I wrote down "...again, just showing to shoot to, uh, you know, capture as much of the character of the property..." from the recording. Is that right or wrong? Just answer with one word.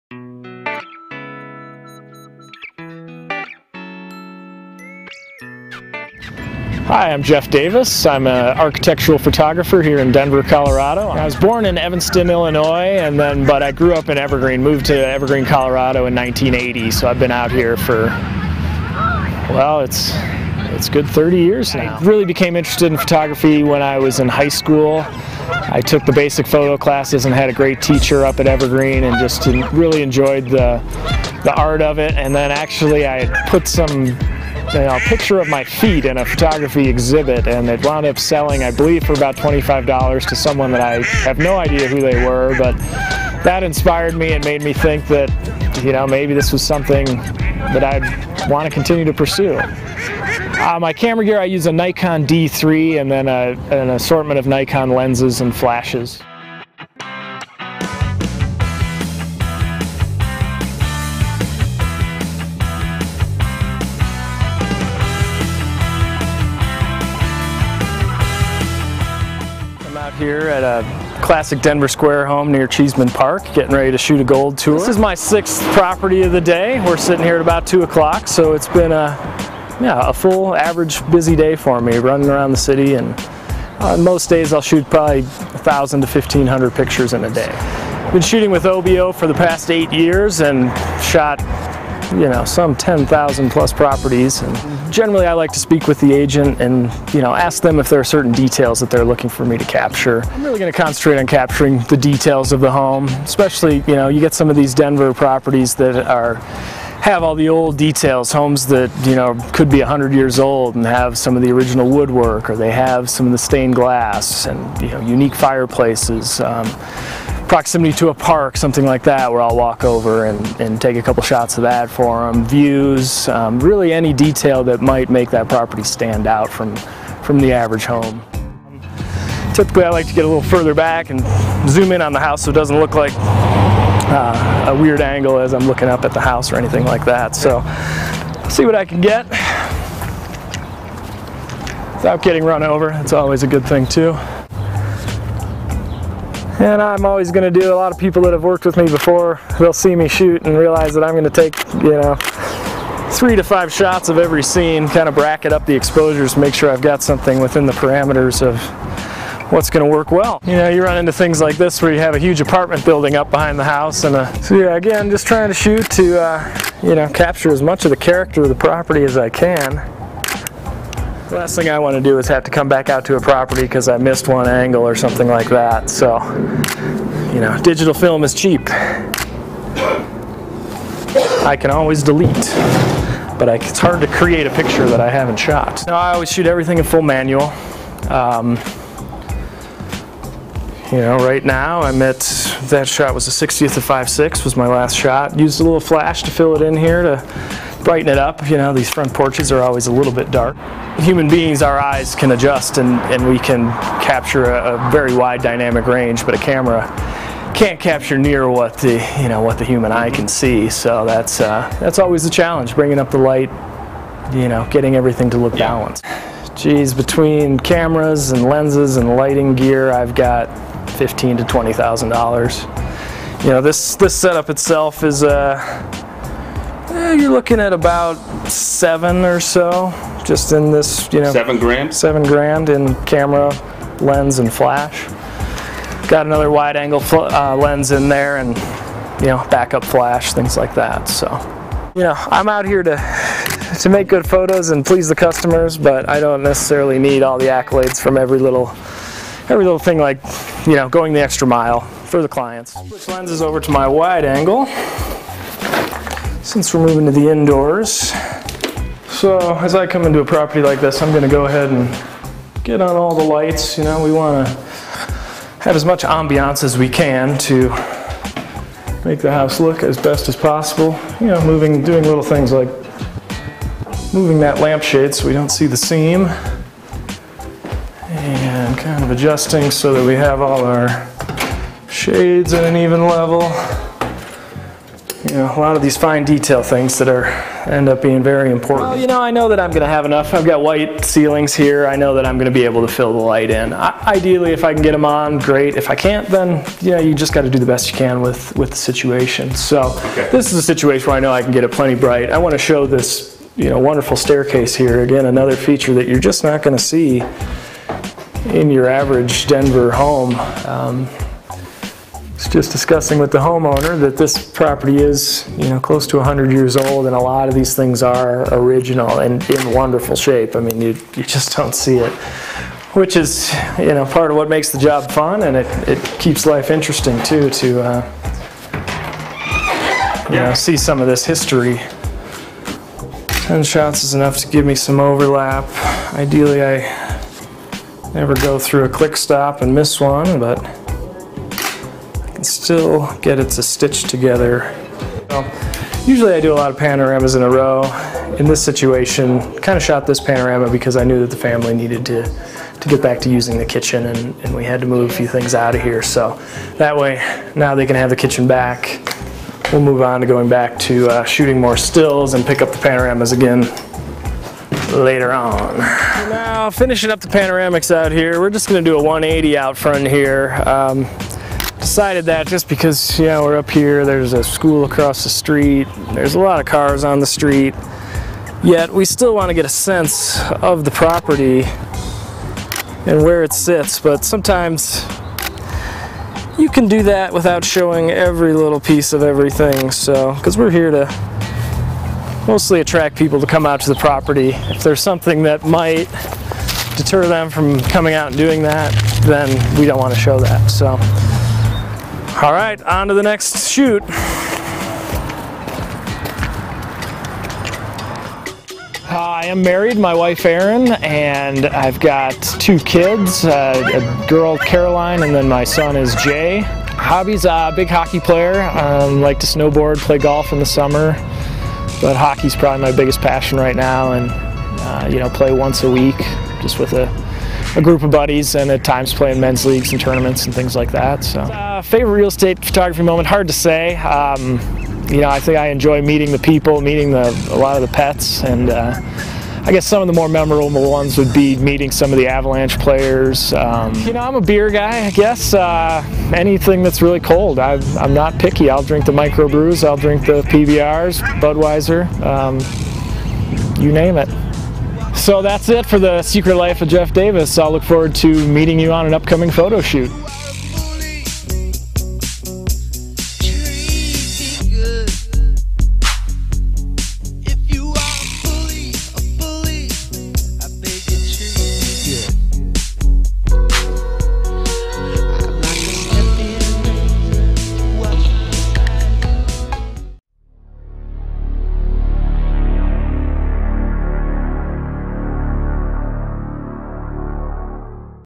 wrong.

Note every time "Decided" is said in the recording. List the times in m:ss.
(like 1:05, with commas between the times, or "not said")
6:11.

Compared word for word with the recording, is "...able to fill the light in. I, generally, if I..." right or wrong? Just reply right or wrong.
wrong.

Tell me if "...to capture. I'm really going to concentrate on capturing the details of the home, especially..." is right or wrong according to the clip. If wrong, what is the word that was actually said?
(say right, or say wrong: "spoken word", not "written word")
right.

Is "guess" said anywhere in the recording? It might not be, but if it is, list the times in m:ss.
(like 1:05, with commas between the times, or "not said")
7:19, 7:25.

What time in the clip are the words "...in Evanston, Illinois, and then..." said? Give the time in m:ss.
0:11.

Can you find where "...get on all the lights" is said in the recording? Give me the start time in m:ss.
4:22.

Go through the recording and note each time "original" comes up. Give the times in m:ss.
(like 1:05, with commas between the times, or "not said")
1:51, 5:18.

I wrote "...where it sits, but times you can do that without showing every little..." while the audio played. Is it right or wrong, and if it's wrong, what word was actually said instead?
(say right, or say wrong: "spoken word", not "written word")
wrong: "sometimes", not "times".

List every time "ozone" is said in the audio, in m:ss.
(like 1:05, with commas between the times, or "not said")
not said.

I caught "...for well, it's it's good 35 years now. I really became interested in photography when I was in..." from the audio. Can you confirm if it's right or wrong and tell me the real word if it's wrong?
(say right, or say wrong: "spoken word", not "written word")
wrong: "30", not "35".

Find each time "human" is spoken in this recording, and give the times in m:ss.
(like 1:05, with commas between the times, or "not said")
3:20, 3:29.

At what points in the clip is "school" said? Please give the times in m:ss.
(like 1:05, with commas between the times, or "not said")
0:24, 6:14.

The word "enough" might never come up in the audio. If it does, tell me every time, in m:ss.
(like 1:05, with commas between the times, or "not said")
4:50, 5:34.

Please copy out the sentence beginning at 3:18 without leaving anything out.
You know, these front porches are always a little bit dark.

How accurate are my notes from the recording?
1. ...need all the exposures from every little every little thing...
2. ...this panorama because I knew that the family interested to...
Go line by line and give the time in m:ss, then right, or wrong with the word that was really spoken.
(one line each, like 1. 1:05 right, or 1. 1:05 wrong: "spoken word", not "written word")
1. 4:06 wrong: "accolades", not "exposures"
2. 5:50 wrong: "needed", not "interested".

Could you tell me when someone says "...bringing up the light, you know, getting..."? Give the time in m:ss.
3:32.